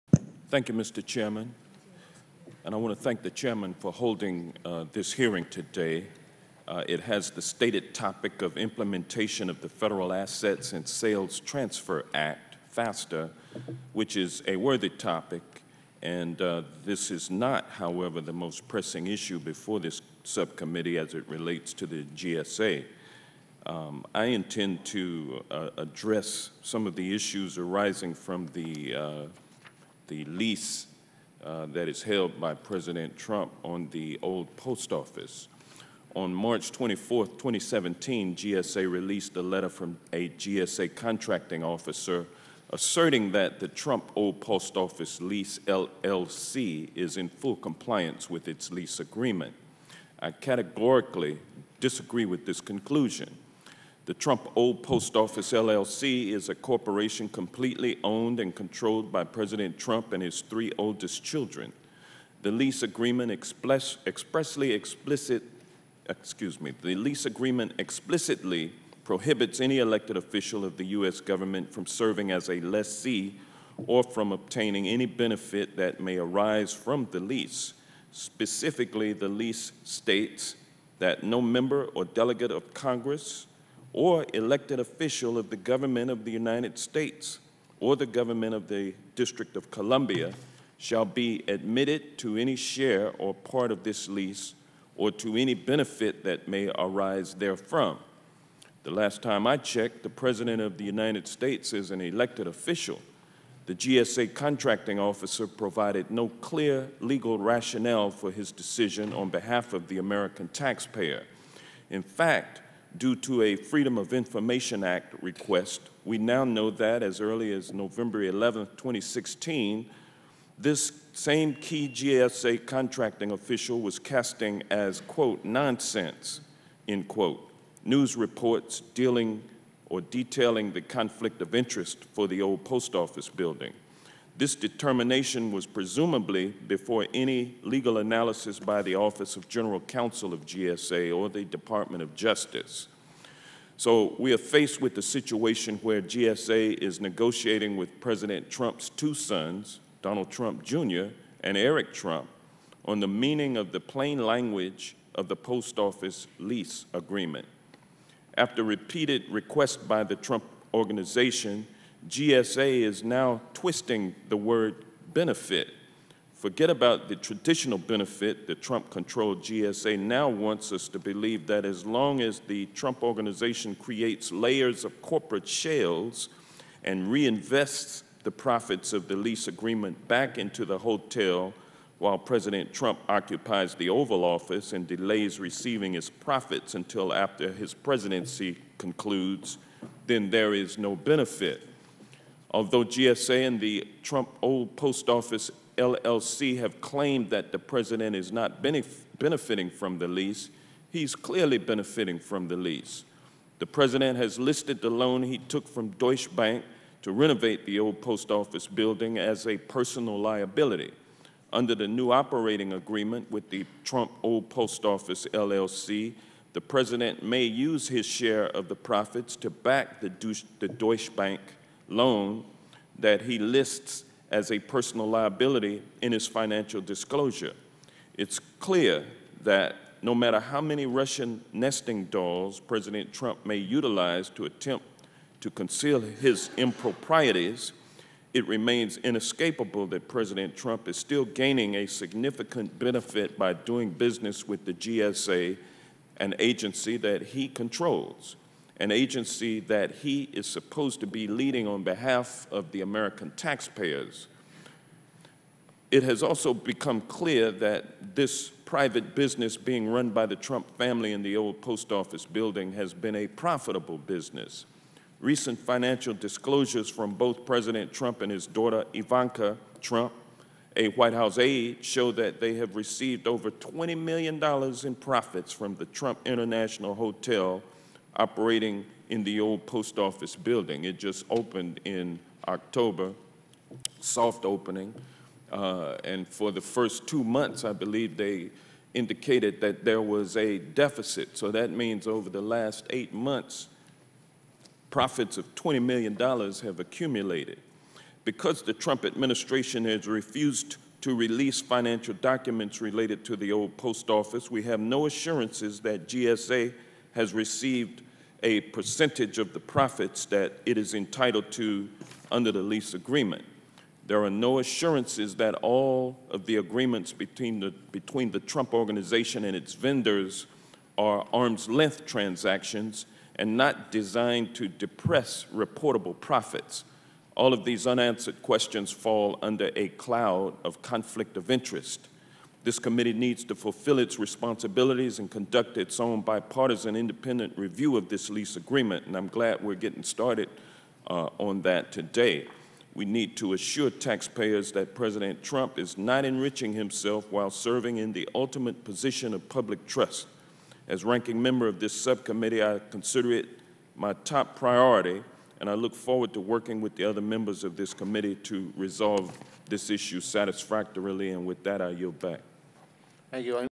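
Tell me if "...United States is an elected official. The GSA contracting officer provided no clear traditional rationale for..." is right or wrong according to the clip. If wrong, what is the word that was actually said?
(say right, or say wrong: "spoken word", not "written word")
wrong: "legal", not "traditional".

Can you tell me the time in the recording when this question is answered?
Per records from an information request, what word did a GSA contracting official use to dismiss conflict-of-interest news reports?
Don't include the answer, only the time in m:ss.
2:05.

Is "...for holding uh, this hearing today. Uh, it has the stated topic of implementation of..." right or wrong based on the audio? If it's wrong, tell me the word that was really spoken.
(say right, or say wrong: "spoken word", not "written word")
right.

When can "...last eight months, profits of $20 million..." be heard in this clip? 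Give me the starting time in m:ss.
4:52.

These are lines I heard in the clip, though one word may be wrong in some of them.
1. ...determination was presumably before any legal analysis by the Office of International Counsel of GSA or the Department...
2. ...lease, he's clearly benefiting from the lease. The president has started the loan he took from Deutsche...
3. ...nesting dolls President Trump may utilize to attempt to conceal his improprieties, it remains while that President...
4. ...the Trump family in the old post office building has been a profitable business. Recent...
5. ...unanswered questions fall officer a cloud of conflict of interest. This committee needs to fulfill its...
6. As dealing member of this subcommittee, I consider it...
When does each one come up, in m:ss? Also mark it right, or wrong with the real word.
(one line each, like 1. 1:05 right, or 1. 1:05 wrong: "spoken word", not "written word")
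1. 2:14 wrong: "General", not "International"
2. 3:20 wrong: "listed", not "started"
3. 3:51 wrong: "inescapable", not "while"
4. 4:20 right
5. 5:27 wrong: "under", not "officer"
6. 5:50 wrong: "ranking", not "dealing".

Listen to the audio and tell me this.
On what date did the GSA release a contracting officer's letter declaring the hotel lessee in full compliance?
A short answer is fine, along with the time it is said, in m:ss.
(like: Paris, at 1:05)
March 24, 2017, at 0:36.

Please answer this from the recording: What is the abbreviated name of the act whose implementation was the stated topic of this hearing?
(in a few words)
FASTA.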